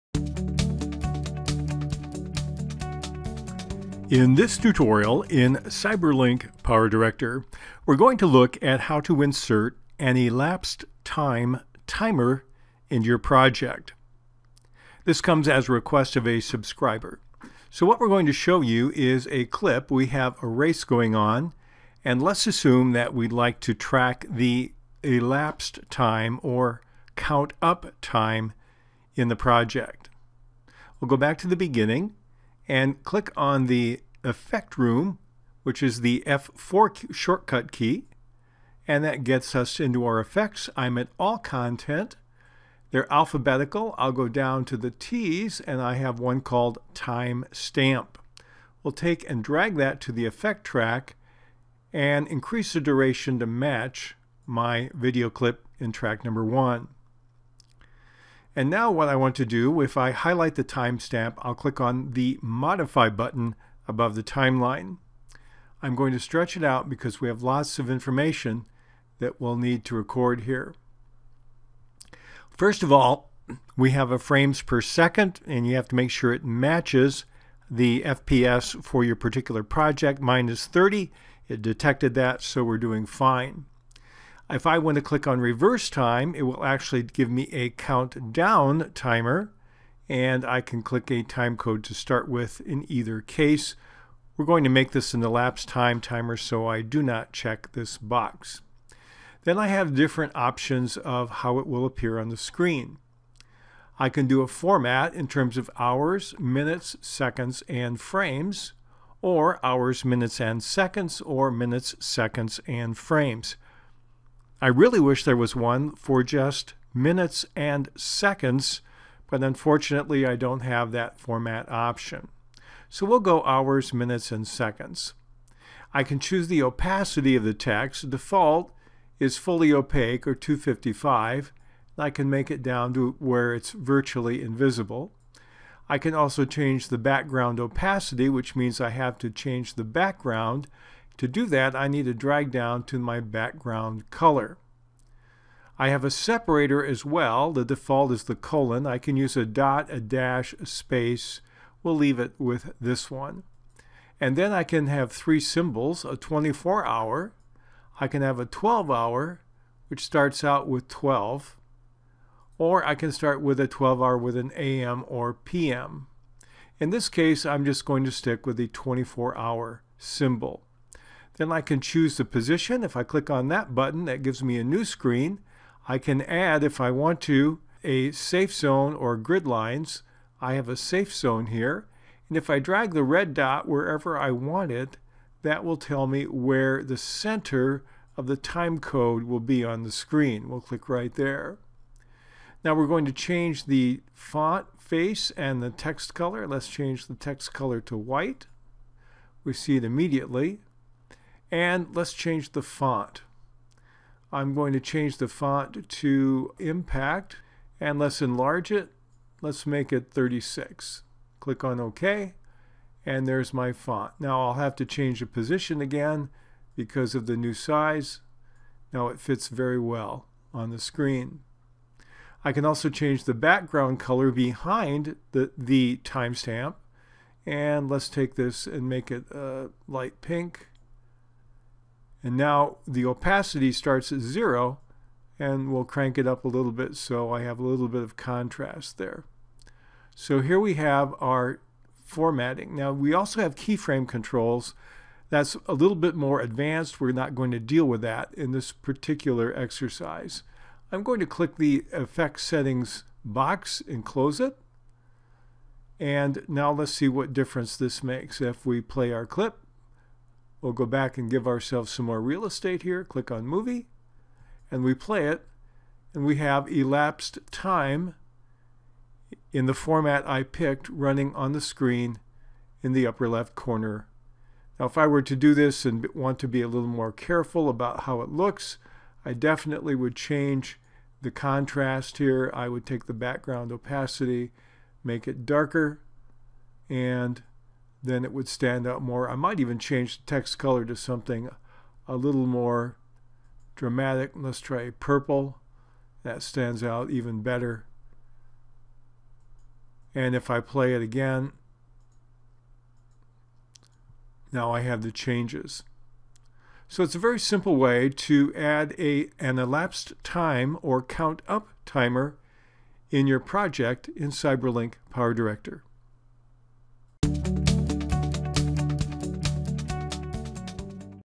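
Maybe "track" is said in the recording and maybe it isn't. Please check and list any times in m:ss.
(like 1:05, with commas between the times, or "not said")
0:23, 0:50, 0:55.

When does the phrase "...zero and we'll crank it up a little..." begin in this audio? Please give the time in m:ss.
3:54.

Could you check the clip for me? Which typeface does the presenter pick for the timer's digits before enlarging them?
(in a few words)
Impact.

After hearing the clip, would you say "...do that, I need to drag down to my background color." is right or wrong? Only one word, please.
right.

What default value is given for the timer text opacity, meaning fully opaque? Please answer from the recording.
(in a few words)
255.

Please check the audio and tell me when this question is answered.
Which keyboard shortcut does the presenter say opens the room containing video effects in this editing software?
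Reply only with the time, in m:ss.
0:36.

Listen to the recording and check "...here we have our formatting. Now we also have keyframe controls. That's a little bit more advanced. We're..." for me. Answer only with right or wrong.
right.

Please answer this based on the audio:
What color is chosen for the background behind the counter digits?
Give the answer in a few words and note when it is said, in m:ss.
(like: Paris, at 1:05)
light pink, at 3:49.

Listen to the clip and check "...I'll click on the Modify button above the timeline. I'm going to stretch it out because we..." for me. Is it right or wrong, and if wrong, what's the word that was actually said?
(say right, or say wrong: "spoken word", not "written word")
right.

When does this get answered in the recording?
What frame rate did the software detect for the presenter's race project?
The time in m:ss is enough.
1:20.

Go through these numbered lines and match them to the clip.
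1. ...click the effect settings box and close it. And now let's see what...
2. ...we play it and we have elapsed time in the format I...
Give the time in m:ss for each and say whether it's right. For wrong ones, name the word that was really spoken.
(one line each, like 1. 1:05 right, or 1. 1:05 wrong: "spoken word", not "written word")
1. 4:11 right
2. 4:24 right.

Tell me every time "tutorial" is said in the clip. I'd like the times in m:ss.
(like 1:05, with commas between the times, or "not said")
0:04.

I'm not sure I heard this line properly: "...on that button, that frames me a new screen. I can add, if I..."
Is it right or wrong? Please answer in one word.
wrong.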